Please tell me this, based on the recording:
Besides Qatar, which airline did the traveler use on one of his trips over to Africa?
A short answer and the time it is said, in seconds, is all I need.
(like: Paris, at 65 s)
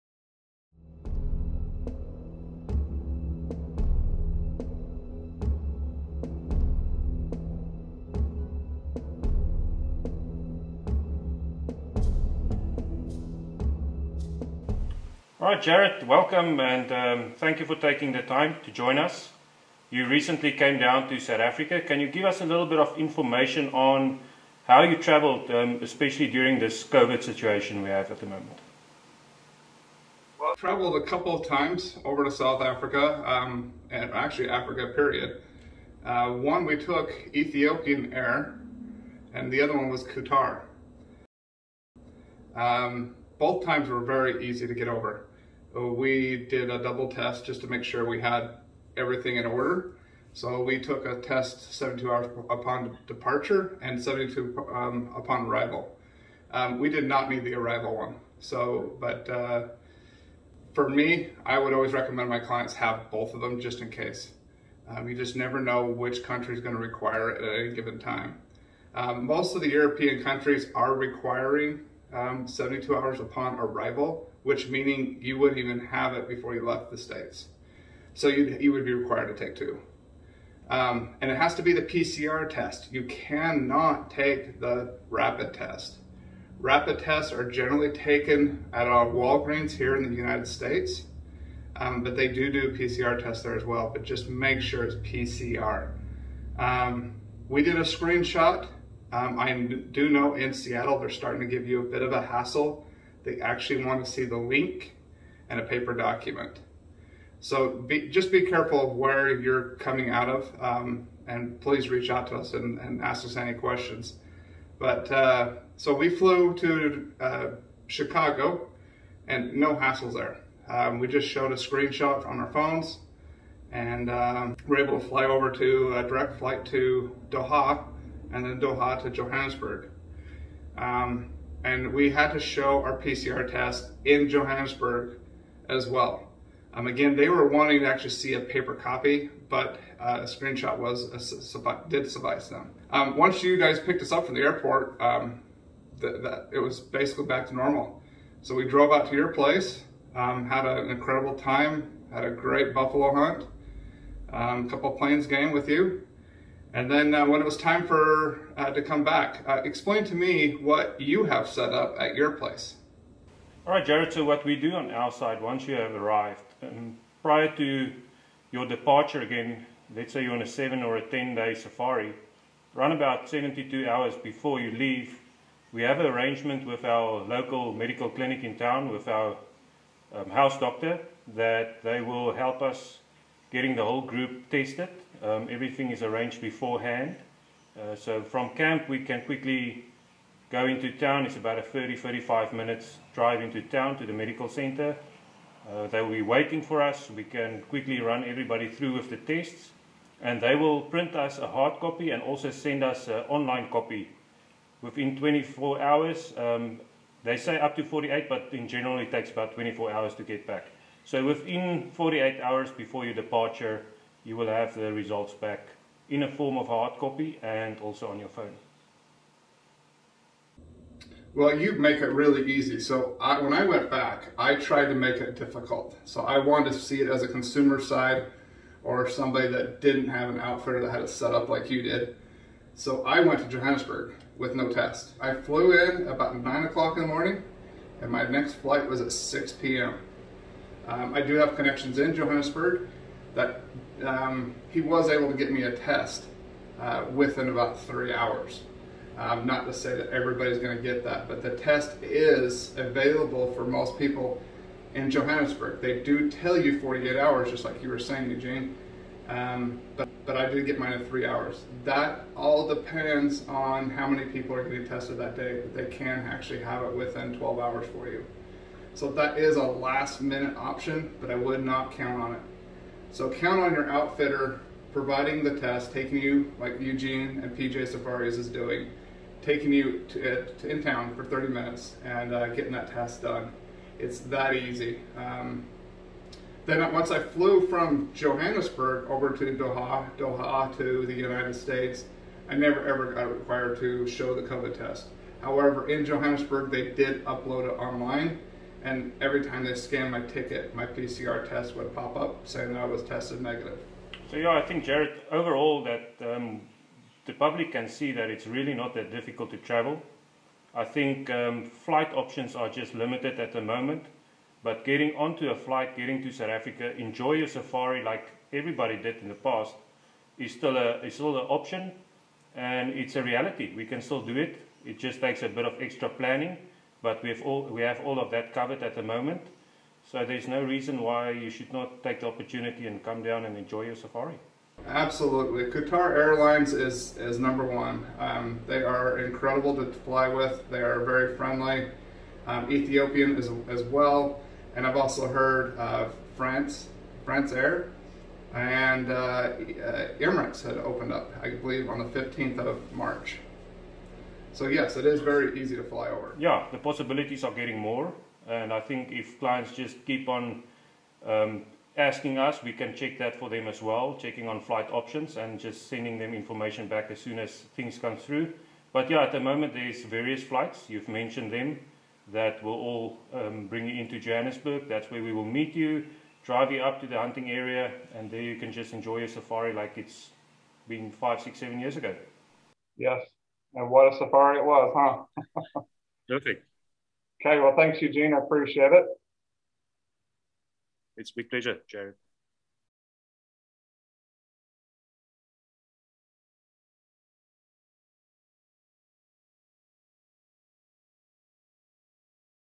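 Ethiopian Air, at 37 s.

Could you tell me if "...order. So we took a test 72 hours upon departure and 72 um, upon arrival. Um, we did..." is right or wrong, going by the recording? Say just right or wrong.
right.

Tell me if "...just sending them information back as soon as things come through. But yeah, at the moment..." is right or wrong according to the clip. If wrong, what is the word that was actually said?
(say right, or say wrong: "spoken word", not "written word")
right.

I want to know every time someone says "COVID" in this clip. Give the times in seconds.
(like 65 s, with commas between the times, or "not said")
26 s, 294 s.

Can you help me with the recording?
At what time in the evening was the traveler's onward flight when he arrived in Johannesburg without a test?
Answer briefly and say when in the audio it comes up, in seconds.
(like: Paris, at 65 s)
6 p.m., at 239 s.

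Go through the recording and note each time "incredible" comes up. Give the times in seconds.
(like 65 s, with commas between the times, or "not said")
150 s, 339 s.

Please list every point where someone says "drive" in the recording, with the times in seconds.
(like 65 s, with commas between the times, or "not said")
193 s, 376 s.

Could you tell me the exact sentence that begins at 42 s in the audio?
Um, both times were very easy to get over.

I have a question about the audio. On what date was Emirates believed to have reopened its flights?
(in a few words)
March 15.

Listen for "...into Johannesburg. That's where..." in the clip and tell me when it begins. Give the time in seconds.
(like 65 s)
374 s.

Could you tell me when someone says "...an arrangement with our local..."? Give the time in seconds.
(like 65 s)
175 s.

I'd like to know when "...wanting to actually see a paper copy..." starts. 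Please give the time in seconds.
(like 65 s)
137 s.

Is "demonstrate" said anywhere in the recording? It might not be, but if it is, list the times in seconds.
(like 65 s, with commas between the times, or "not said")
not said.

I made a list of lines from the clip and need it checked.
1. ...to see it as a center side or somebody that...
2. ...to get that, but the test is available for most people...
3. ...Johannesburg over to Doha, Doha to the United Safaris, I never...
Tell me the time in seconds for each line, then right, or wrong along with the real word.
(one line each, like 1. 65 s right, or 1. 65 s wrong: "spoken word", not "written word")
1. 226 s wrong: "consumer", not "center"
2. 250 s right
3. 288 s wrong: "States", not "Safaris".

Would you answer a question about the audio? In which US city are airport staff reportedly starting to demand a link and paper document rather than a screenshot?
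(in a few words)
Seattle.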